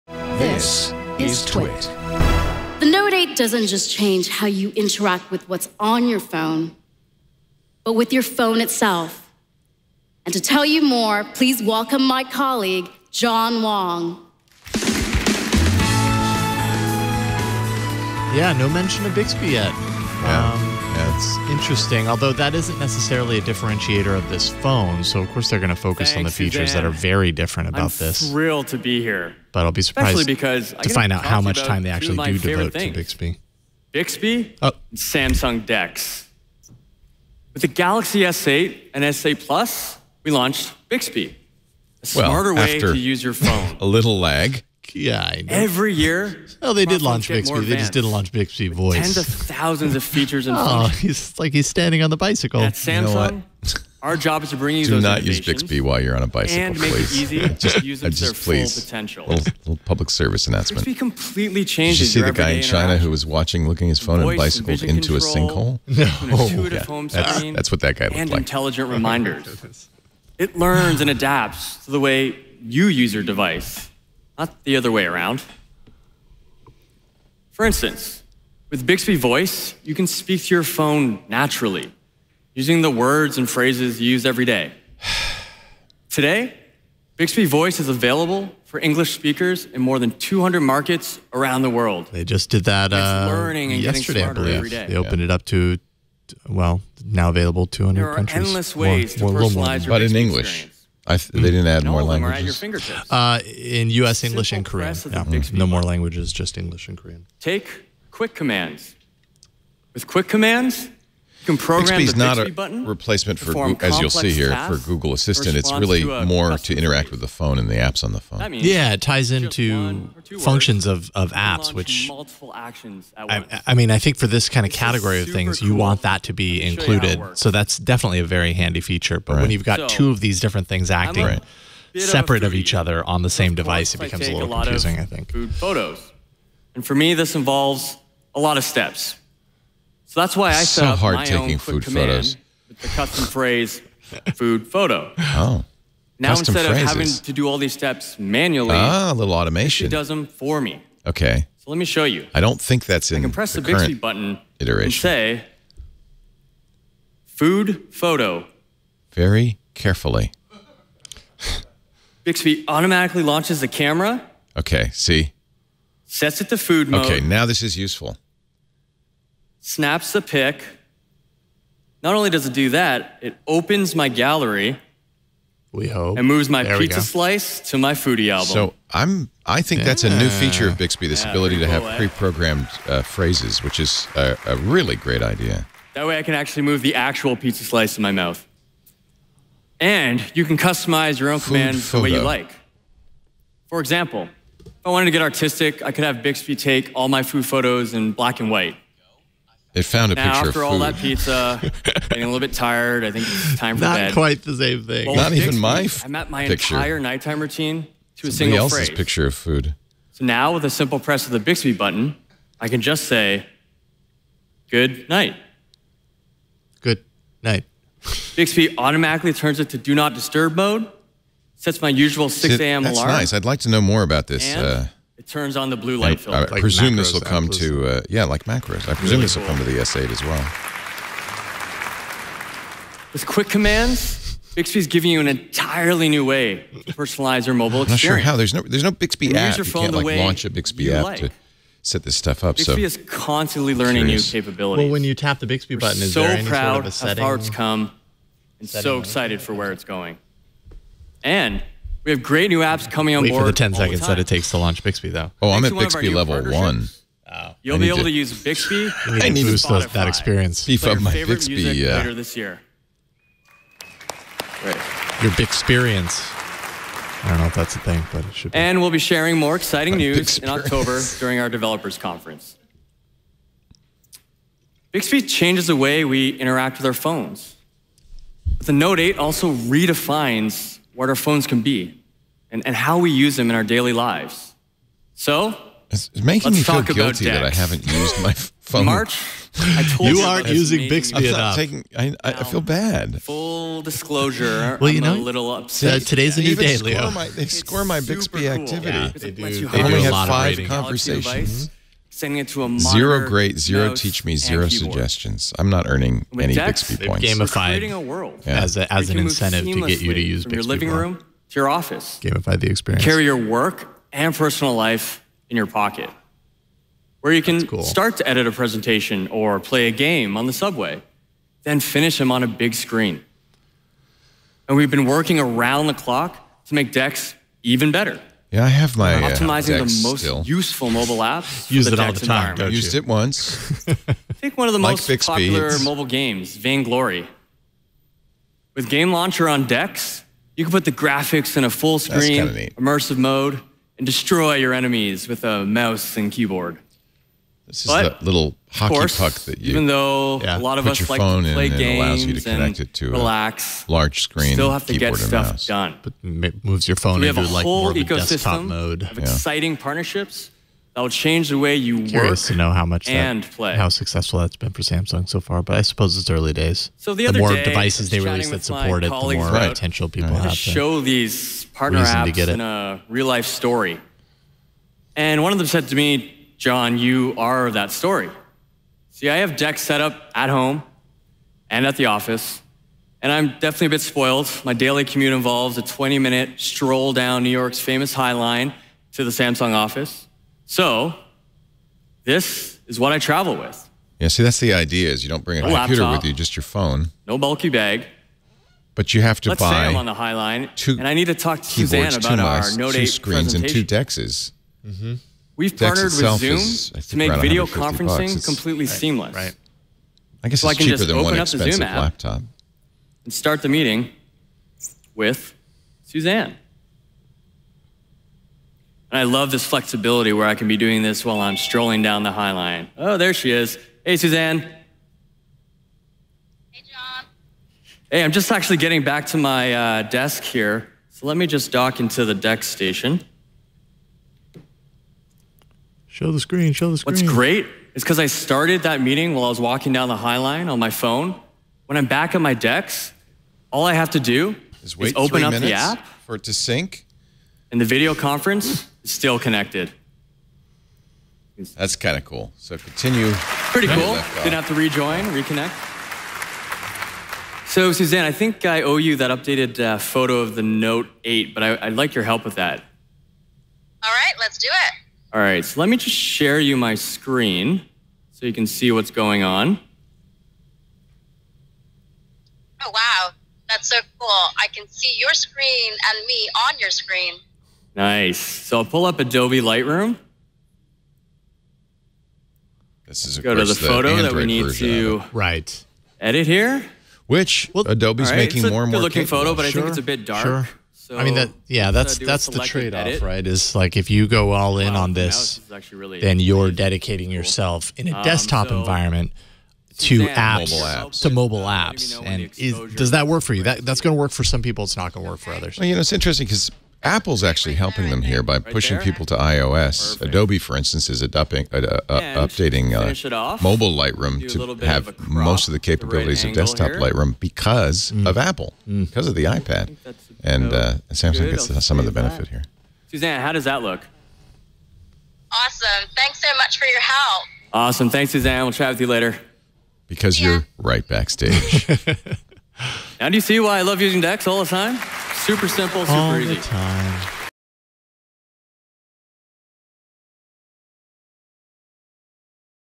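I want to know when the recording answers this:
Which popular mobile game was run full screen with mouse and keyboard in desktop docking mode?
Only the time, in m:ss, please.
5:36.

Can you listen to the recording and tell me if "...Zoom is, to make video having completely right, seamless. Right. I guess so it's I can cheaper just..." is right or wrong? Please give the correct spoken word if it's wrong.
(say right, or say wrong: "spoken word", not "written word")
wrong: "conferencing", not "having".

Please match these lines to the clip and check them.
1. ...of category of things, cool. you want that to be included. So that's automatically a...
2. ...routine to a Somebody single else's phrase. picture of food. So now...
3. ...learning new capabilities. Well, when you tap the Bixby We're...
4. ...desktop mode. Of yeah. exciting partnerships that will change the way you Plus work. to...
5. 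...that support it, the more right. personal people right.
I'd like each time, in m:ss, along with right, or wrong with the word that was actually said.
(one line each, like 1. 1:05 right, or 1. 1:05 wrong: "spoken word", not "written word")
1. 2:04 wrong: "definitely", not "automatically"
2. 3:27 right
3. 4:03 right
4. 5:58 wrong: "Curious", not "Plus"
5. 6:08 wrong: "potential", not "personal".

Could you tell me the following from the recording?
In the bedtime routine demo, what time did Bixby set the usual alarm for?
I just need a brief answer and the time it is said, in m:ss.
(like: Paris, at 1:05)
6 a.m., at 3:42.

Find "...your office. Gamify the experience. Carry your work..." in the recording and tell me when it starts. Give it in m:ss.
5:11.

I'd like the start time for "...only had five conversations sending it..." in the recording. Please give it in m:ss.
4:59.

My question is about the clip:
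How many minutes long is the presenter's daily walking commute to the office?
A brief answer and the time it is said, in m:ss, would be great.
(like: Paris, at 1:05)
20 minutes, at 6:25.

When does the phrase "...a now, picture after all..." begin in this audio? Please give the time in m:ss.
3:20.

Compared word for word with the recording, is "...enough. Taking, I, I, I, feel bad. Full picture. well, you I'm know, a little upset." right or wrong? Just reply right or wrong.
wrong.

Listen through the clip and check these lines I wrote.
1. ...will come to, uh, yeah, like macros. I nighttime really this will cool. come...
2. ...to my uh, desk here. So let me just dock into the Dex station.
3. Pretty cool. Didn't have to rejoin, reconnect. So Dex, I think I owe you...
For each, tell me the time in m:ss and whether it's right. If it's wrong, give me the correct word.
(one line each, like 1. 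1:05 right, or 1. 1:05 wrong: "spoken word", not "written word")
1. 3:47 wrong: "presume", not "nighttime"
2. 7:09 right
3. 7:33 wrong: "Suzanne", not "Dex".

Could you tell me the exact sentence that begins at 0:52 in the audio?
At Samsung, you know our job is to bring you.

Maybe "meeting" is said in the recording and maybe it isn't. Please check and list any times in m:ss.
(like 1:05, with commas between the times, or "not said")
6:53, 7:18.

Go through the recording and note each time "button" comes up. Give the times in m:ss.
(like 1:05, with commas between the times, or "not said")
1:52, 2:33, 3:31, 4:05.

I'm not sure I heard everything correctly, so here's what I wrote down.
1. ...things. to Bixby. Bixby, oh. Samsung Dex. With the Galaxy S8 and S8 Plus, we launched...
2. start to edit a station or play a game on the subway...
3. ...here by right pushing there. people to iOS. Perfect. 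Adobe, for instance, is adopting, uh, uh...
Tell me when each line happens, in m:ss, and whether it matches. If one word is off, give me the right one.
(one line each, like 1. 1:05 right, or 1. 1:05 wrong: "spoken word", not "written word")
1. 0:32 right
2. 5:17 wrong: "presentation", not "station"
3. 8:28 right.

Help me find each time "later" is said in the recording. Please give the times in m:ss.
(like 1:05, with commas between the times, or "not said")
4:21, 8:49.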